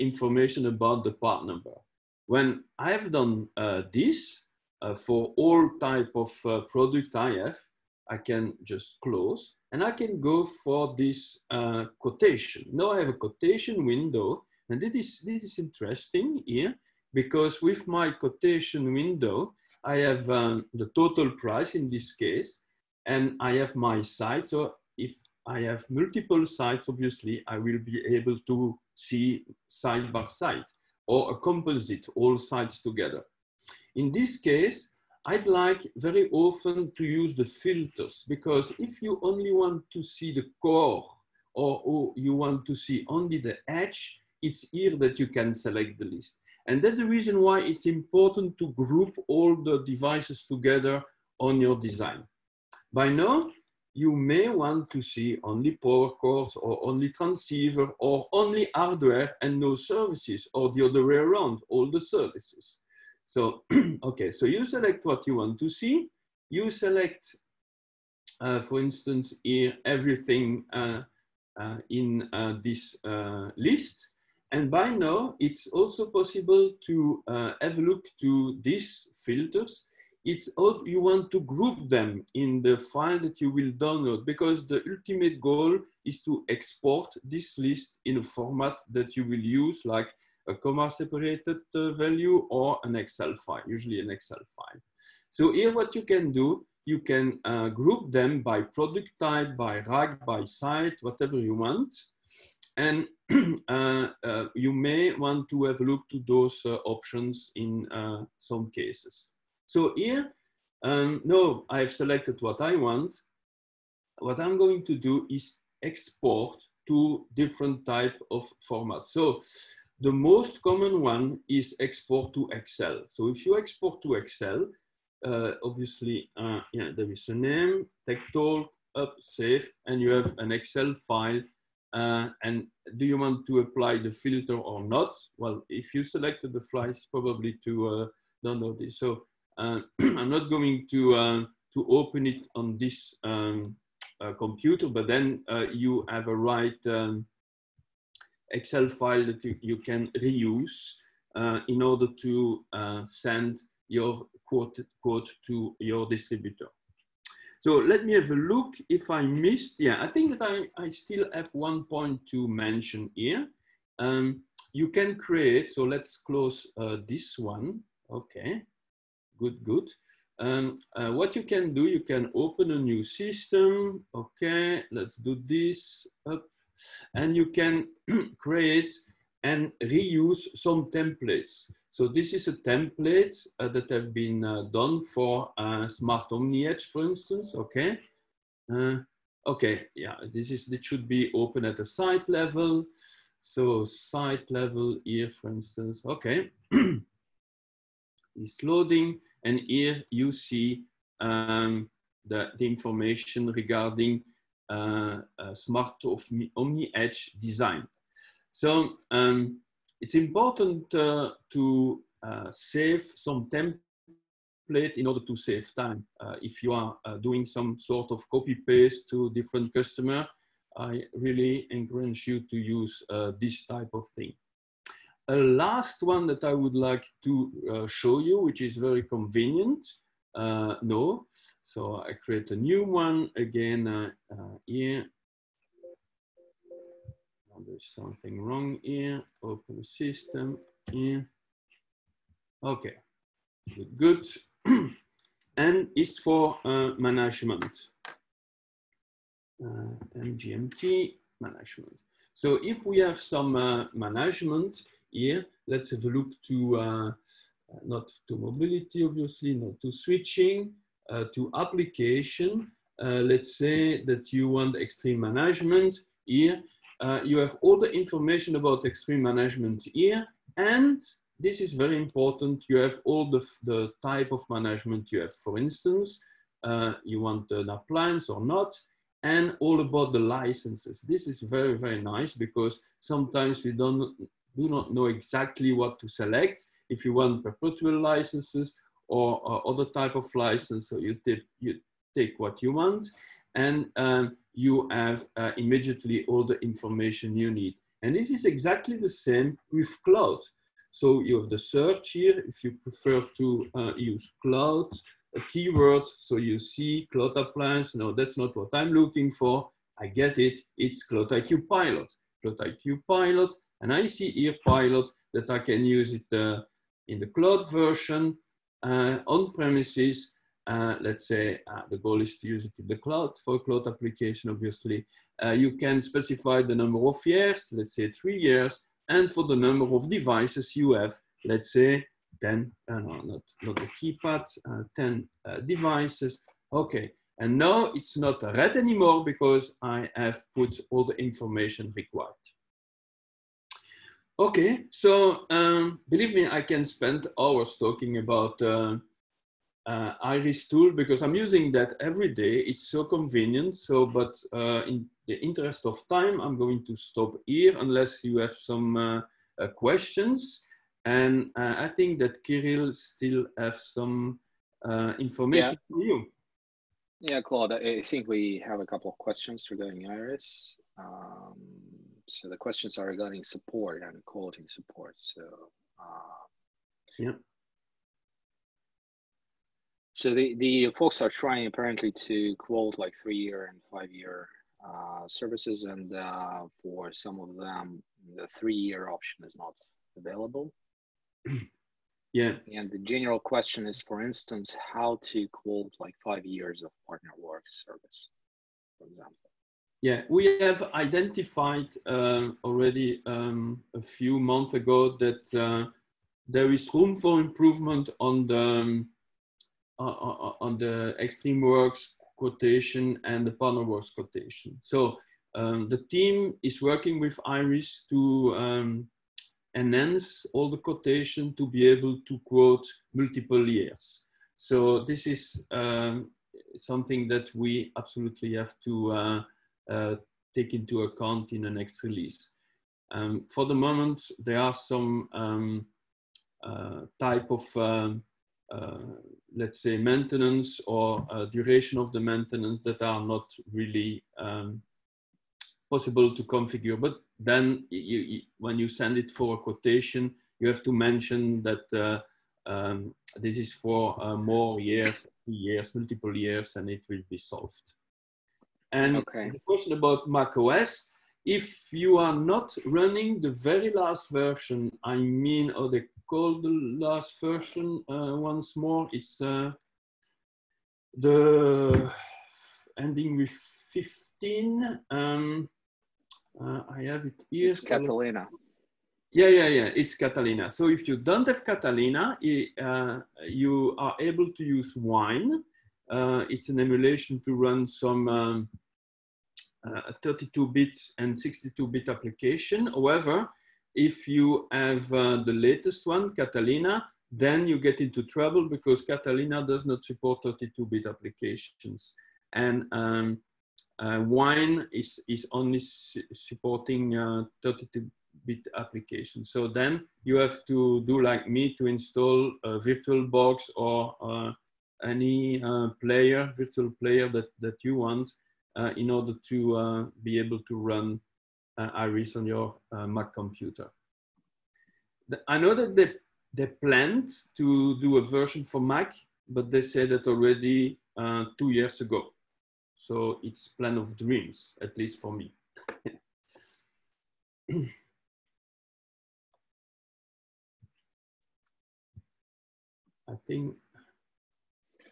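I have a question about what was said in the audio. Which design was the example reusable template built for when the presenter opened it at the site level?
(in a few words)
Smart Omni Edge.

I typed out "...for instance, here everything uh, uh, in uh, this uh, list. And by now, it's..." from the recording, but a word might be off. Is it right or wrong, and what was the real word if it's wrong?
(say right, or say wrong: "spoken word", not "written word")
right.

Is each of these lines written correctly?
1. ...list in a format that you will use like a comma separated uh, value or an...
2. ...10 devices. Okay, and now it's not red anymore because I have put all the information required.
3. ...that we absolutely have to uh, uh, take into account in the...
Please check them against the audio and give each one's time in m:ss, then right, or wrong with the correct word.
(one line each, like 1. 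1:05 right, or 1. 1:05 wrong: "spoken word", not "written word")
1. 1:27 right
2. 5:34 right
3. 7:07 right.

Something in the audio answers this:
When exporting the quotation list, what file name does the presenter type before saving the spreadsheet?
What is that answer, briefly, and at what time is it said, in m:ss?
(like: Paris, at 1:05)
TechTalk, at 2:08.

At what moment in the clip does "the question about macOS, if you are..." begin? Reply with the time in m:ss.
7:39.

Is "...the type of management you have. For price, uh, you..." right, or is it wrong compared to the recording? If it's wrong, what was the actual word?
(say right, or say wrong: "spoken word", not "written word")
wrong: "instance", not "price".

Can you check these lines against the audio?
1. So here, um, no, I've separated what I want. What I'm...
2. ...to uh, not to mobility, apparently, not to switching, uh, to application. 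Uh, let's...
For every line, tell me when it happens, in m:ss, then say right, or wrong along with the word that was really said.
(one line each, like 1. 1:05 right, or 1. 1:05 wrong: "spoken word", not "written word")
1. 1:49 wrong: "selected", not "separated"
2. 4:16 wrong: "obviously", not "apparently".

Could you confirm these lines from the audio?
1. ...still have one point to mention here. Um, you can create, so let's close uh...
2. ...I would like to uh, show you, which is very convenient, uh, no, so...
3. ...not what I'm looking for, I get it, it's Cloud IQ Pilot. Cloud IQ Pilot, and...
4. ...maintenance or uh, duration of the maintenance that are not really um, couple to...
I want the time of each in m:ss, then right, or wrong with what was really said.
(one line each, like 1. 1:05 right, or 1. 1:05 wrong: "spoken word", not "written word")
1. 2:40 right
2. 3:46 right
3. 5:08 right
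4. 7:19 wrong: "possible", not "couple".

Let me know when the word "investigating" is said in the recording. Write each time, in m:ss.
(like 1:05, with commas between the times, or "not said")
not said.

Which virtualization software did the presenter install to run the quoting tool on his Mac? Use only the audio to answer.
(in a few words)
VirtualBox.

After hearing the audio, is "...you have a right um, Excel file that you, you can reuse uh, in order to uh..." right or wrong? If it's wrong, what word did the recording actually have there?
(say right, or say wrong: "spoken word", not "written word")
right.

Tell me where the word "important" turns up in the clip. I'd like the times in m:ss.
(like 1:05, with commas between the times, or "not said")
0:47, 3:30, 4:31.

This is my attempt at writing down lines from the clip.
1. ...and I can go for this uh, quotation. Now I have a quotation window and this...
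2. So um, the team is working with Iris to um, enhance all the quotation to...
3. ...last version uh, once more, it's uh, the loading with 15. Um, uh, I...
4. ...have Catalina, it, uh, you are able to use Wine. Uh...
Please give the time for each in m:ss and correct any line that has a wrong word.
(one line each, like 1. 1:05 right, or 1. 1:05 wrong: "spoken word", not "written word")
1. 0:09 right
2. 6:54 right
3. 7:46 wrong: "ending", not "loading"
4. 8:01 right.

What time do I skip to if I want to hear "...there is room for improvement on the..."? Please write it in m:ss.
6:46.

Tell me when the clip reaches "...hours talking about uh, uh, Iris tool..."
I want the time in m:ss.
5:47.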